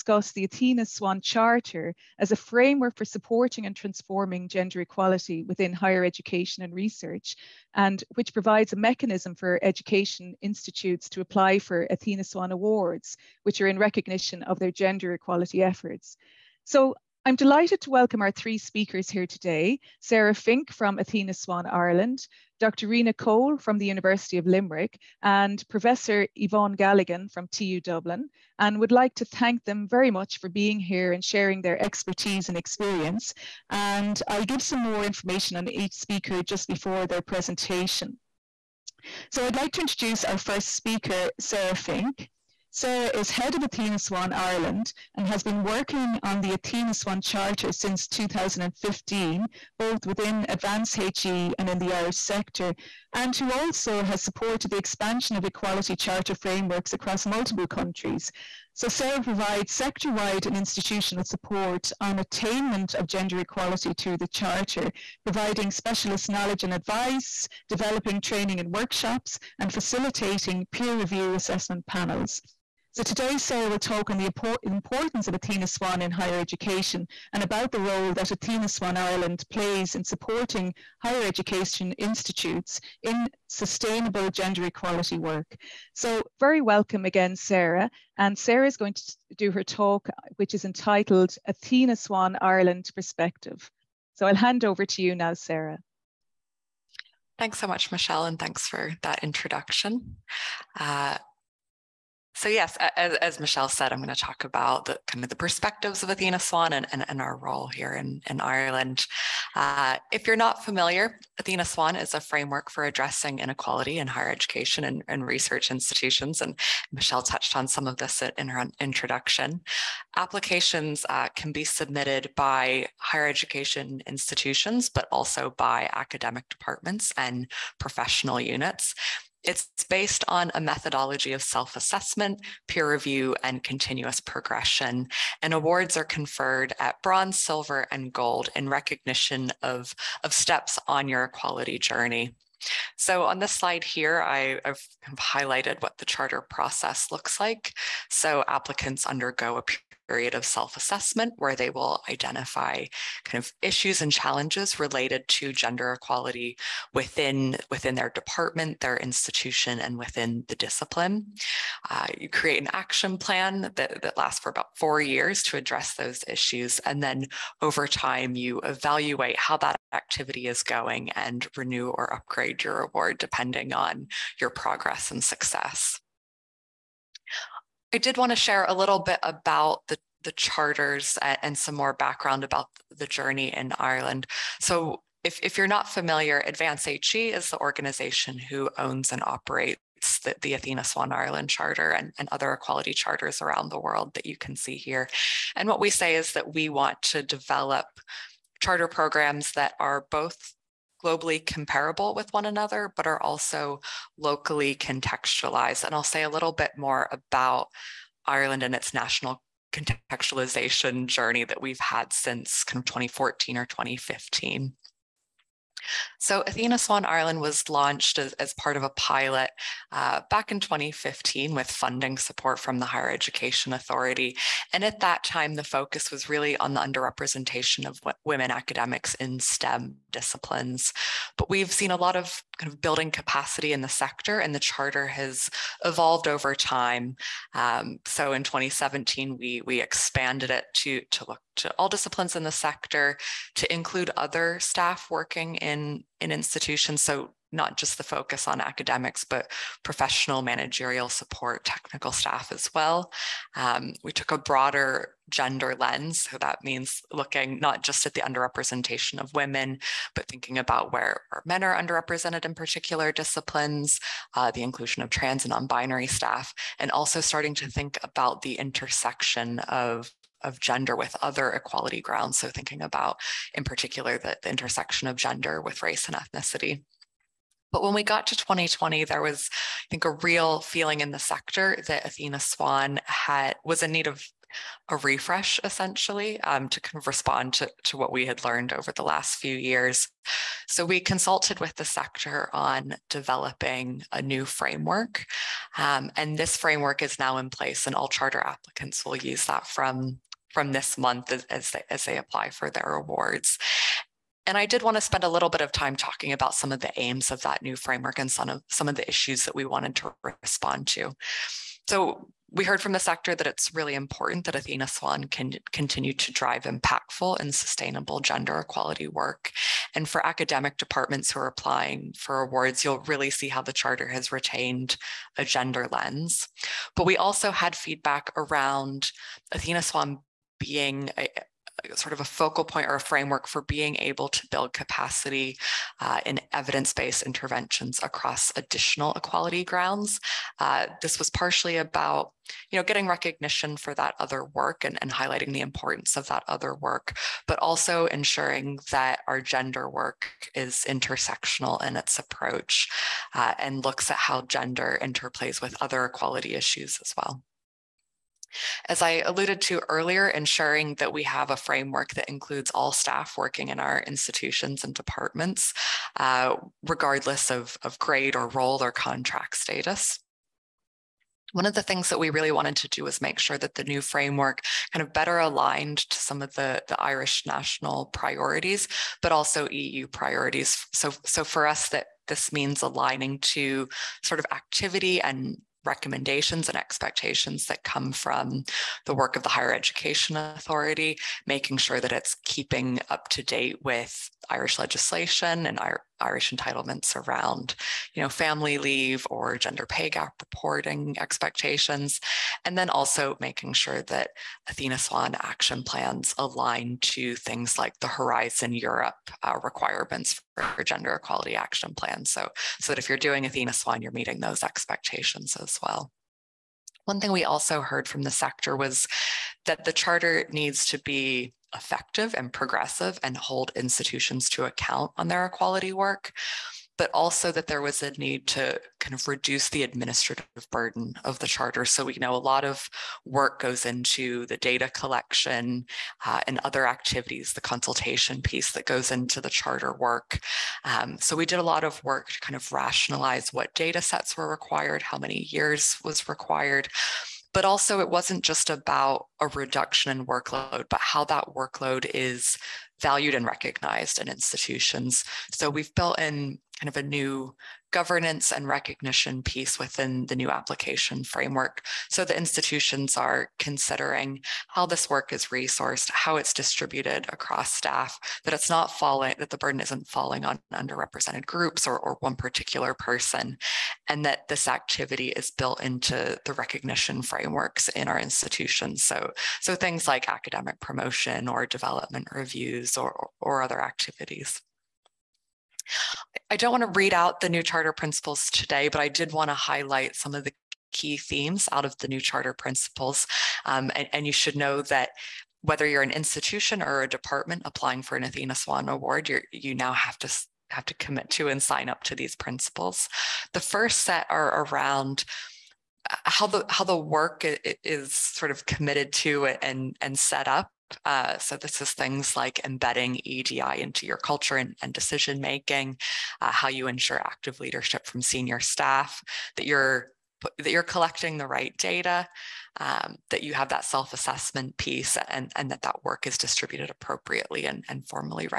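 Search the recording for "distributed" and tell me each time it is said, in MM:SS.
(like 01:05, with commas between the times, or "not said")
07:46, 08:46.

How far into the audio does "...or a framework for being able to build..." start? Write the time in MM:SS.
05:32.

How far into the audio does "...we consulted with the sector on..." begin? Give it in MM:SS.
04:50.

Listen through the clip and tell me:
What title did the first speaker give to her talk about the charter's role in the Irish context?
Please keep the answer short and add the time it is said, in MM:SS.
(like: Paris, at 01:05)
Athena Swan Ireland Perspective, at 01:31.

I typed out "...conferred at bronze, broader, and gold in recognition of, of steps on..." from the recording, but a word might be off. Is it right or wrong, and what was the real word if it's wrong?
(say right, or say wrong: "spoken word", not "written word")
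wrong: "silver", not "broader".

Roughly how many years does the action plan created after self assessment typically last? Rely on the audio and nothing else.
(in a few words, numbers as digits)
4.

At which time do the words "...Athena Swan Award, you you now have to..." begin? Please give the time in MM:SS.
08:18.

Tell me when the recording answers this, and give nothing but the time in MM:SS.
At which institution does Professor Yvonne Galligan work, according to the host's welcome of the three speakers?
00:27.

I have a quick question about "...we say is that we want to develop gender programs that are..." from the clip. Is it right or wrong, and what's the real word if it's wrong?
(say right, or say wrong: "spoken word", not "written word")
wrong: "charter", not "gender".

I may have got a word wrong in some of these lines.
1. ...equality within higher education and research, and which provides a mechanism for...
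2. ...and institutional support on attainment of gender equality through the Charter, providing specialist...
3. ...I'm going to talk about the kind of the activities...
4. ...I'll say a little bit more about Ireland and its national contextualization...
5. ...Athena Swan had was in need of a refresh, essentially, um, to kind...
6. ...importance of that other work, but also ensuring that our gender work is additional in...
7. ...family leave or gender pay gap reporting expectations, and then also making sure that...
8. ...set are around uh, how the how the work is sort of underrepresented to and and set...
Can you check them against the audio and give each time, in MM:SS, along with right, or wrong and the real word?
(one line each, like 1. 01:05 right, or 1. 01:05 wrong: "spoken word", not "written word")
1. 00:04 right
2. 01:00 right
3. 01:43 wrong: "perspectives", not "activities"
4. 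03:25 right
5. 04:42 right
6. 05:45 wrong: "intersectional", not "additional"
7. 06:38 right
8. 08:23 wrong: "committed", not "underrepresented".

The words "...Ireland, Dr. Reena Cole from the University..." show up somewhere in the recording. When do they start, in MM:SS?
00:21.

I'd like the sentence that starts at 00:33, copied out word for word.
And I'll give some more information on each speaker just before their presentation.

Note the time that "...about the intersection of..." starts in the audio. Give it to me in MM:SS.
04:28.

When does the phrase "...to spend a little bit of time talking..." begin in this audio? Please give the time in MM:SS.
05:04.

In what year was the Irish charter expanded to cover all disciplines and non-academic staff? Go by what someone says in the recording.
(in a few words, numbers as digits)
2017.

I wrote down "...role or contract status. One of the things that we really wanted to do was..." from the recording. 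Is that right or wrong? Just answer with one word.
right.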